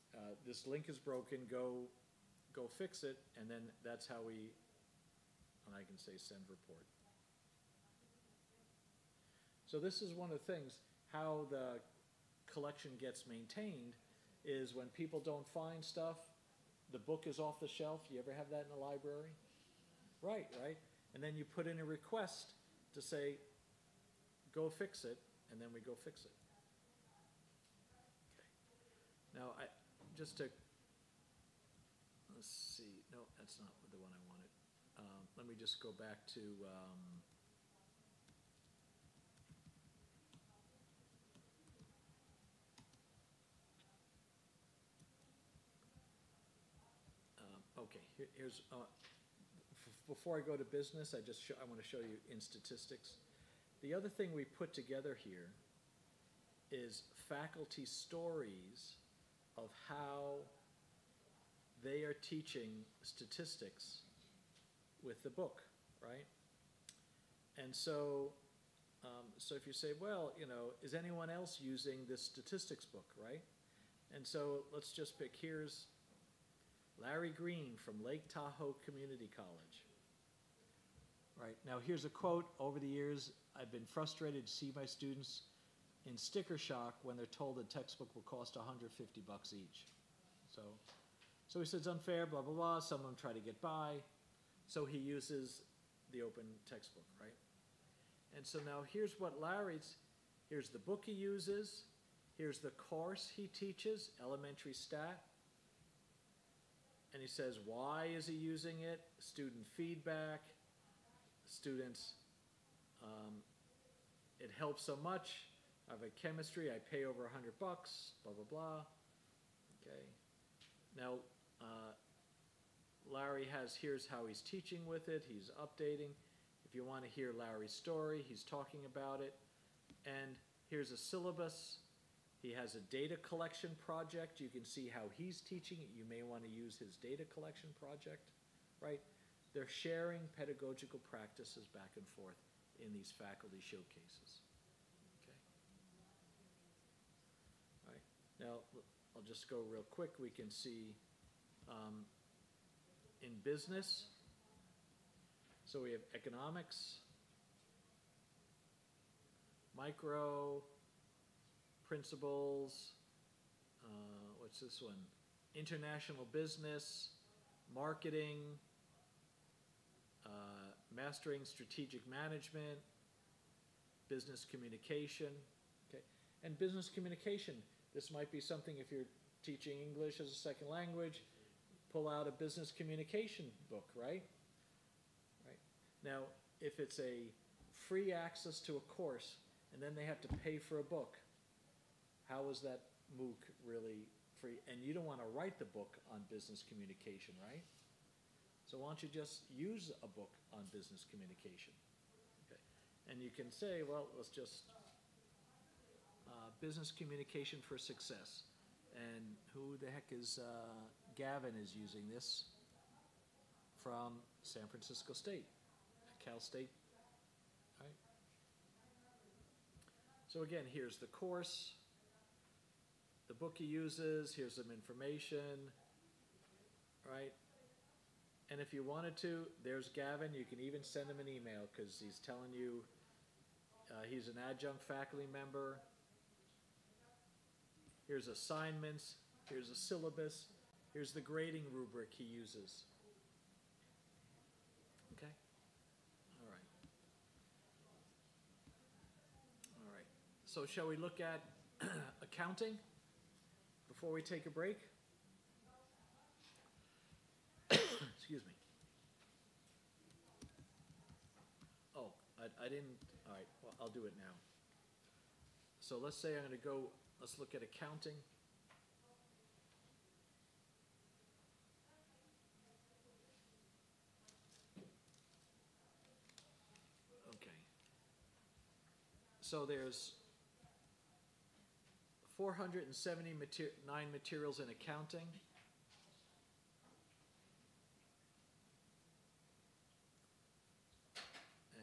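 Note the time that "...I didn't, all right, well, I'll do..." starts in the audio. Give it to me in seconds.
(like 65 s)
262 s.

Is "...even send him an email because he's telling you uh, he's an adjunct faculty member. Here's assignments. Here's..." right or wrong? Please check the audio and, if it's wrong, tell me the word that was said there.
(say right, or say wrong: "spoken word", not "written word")
right.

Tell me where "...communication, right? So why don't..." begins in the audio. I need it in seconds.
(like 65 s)
196 s.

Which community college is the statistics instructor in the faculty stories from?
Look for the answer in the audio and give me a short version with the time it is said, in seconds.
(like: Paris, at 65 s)
Lake Tahoe Community College, at 78 s.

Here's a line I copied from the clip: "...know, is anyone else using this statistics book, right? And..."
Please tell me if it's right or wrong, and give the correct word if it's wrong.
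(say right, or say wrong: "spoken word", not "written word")
right.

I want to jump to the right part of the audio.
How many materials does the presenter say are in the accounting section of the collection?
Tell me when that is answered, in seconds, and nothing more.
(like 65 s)
282 s.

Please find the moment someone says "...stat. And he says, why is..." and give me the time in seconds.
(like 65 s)
104 s.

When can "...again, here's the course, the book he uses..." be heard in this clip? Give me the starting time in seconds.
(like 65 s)
220 s.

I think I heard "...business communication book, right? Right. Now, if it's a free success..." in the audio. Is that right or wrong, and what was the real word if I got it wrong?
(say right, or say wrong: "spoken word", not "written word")
wrong: "access", not "success".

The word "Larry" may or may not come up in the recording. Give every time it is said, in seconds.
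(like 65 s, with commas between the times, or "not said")
77 s, 99 s, 123 s, 127 s.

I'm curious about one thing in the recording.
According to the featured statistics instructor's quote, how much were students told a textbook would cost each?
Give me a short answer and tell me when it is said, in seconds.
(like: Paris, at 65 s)
$150, at 88 s.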